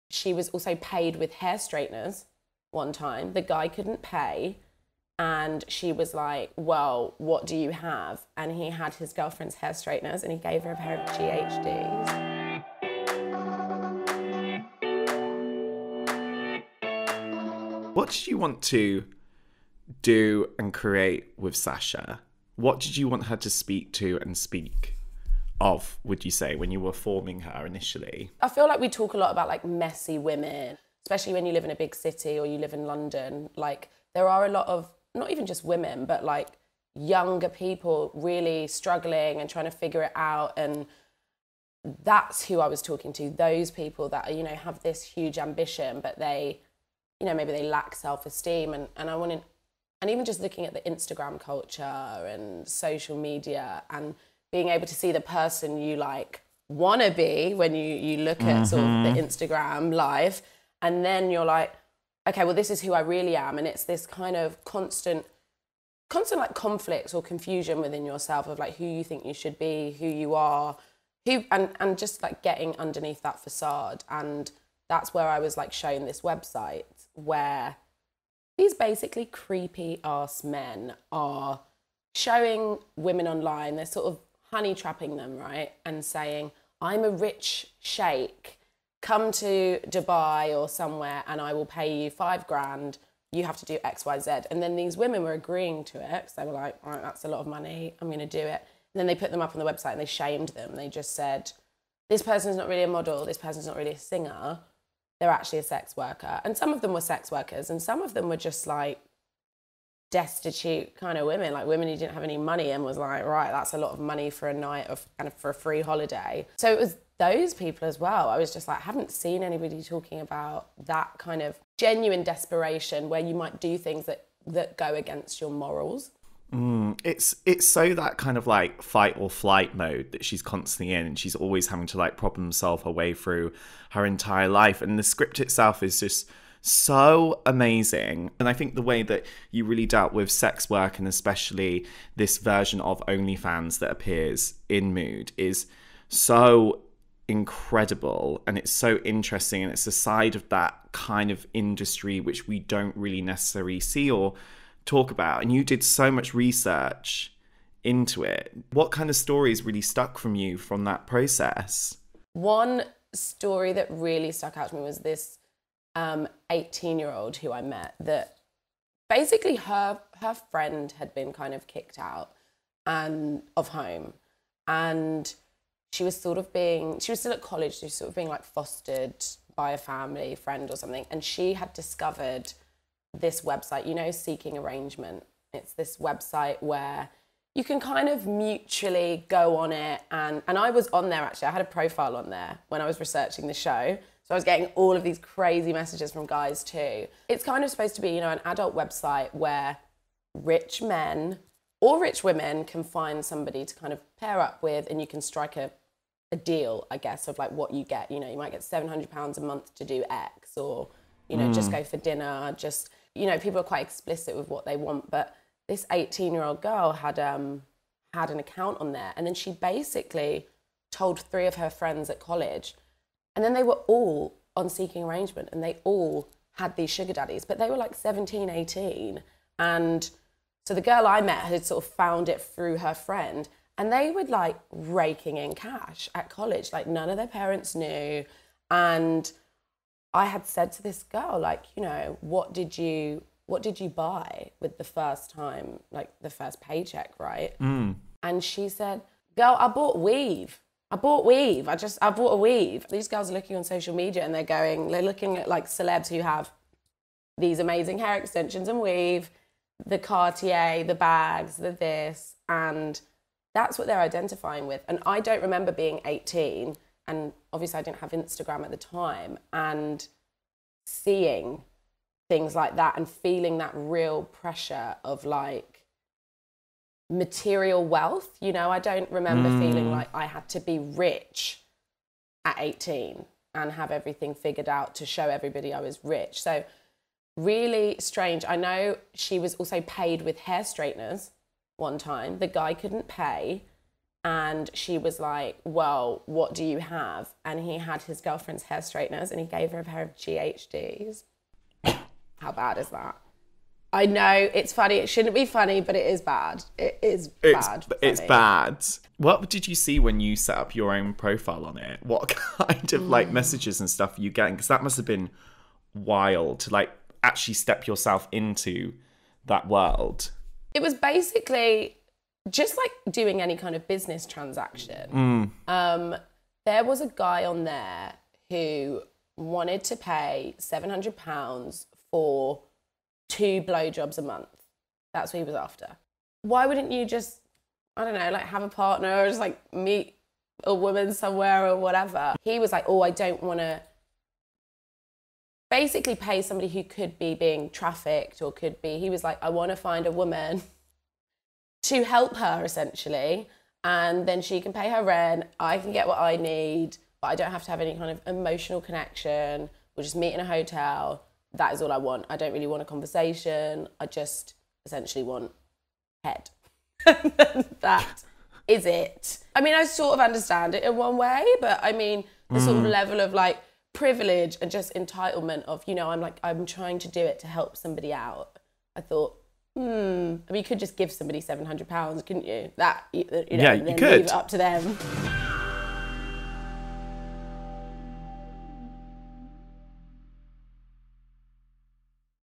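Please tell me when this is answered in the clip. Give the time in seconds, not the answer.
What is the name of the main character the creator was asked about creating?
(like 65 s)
21 s.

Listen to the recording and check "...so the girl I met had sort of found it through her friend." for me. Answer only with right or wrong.
right.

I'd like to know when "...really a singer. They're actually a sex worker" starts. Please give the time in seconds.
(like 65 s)
103 s.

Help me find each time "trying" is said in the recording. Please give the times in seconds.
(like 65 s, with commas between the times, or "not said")
39 s, 376 s.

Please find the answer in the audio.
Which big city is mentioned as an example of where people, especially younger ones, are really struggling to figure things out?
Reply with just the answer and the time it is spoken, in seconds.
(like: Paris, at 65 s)
London, at 32 s.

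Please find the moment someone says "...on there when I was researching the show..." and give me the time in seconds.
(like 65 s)
192 s.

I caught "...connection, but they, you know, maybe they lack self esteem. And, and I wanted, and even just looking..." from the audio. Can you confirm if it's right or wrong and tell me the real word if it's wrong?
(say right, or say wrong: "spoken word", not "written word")
wrong: "ambition", not "connection".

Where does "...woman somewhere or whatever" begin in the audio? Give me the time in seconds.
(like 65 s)
340 s.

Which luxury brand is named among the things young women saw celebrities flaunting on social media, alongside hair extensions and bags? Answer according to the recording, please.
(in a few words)
Cartier.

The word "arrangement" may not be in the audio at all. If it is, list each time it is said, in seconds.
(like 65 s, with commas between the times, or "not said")
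184 s, 225 s.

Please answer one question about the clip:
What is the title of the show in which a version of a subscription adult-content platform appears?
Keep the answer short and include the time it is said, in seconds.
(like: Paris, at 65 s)
Mood, at 144 s.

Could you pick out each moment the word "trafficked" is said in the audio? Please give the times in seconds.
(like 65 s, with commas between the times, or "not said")
347 s.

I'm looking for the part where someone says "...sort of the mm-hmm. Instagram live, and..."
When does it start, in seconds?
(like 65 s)
58 s.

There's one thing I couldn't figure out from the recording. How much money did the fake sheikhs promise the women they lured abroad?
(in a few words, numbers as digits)
five grand.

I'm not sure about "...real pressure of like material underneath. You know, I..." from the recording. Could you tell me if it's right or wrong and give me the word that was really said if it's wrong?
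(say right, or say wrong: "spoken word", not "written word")
wrong: "wealth", not "underneath".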